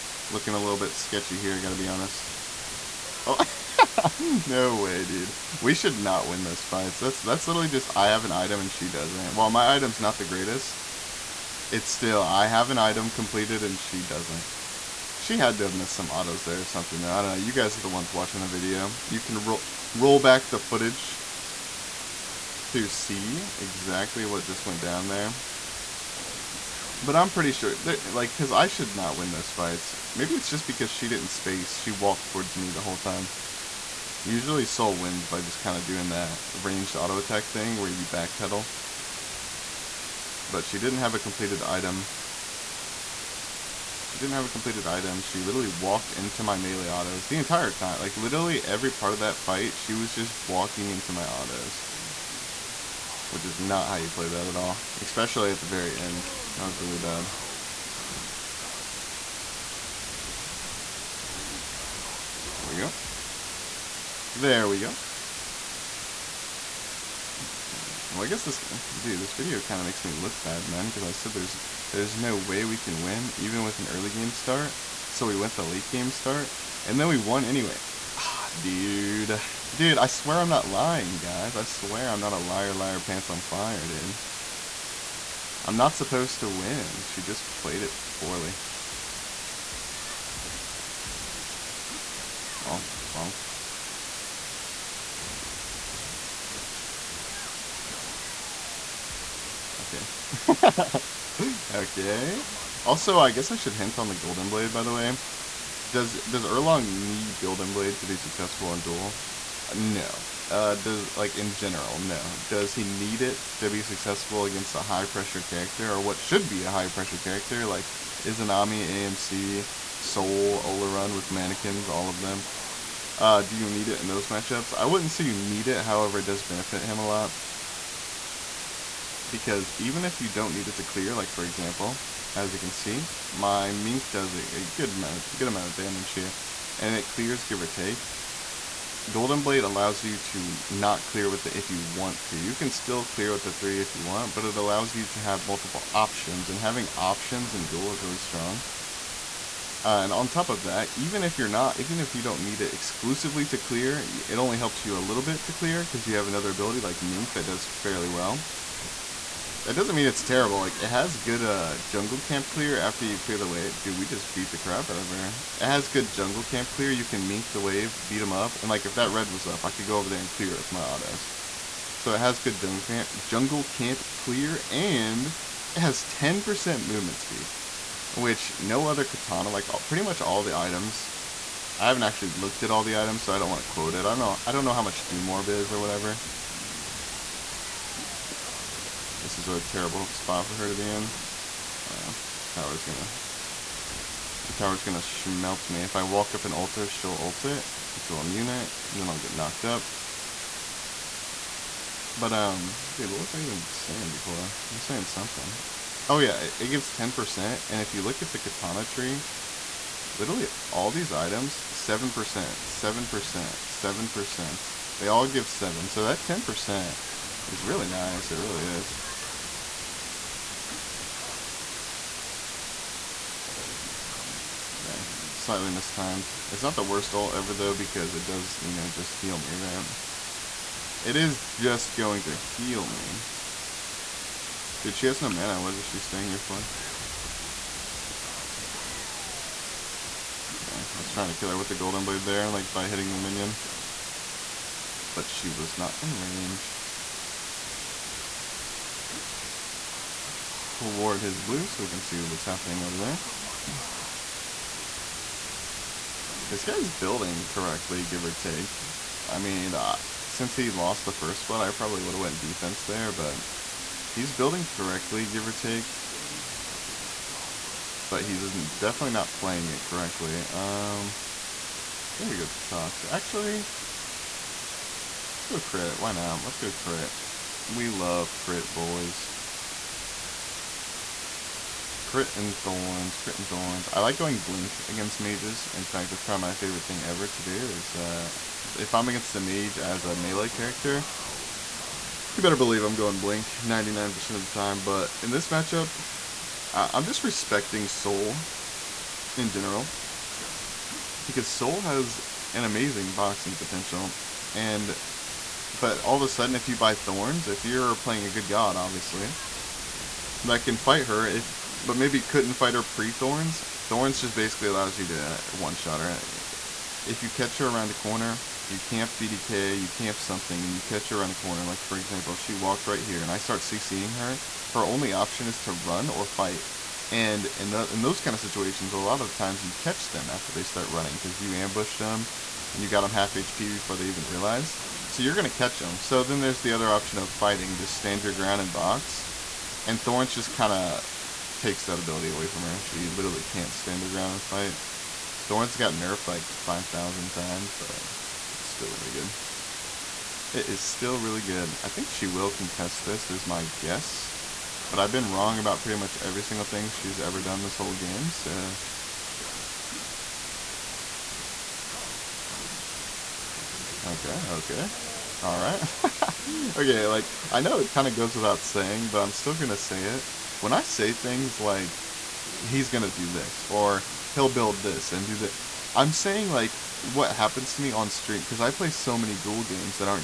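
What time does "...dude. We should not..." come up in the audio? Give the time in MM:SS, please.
00:05.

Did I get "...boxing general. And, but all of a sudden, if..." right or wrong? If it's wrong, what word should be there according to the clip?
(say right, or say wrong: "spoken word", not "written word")
wrong: "potential", not "general".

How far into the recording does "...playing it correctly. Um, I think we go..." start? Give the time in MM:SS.
04:29.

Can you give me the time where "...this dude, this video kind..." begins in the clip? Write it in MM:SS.
01:08.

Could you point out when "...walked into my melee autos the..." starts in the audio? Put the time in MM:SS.
00:45.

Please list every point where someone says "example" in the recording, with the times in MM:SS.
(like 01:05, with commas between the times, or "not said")
02:11, 05:21.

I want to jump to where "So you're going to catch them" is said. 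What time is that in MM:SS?
05:35.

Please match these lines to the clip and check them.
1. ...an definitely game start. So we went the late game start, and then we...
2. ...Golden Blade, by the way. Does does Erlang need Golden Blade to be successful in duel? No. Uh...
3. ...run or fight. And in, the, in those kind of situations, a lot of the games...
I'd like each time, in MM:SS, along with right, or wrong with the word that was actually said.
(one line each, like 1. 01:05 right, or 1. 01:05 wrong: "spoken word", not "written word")
1. 01:13 wrong: "early", not "definitely"
2. 01:44 right
3. 05:25 wrong: "times", not "games".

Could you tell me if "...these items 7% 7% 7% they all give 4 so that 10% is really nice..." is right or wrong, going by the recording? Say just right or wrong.
wrong.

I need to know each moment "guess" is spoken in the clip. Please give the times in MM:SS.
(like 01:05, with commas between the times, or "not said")
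01:08, 01:43, 05:53.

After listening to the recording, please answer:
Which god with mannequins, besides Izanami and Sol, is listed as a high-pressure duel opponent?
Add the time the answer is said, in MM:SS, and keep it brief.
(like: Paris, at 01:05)
Olorun, at 02:00.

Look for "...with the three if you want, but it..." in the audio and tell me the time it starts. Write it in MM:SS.
02:23.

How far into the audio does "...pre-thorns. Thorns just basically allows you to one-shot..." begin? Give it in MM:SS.
05:12.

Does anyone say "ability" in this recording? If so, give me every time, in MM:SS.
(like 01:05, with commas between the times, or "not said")
02:36, 05:41.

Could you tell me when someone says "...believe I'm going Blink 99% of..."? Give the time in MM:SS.
04:52.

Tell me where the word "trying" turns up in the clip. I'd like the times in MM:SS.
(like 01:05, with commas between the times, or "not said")
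04:01.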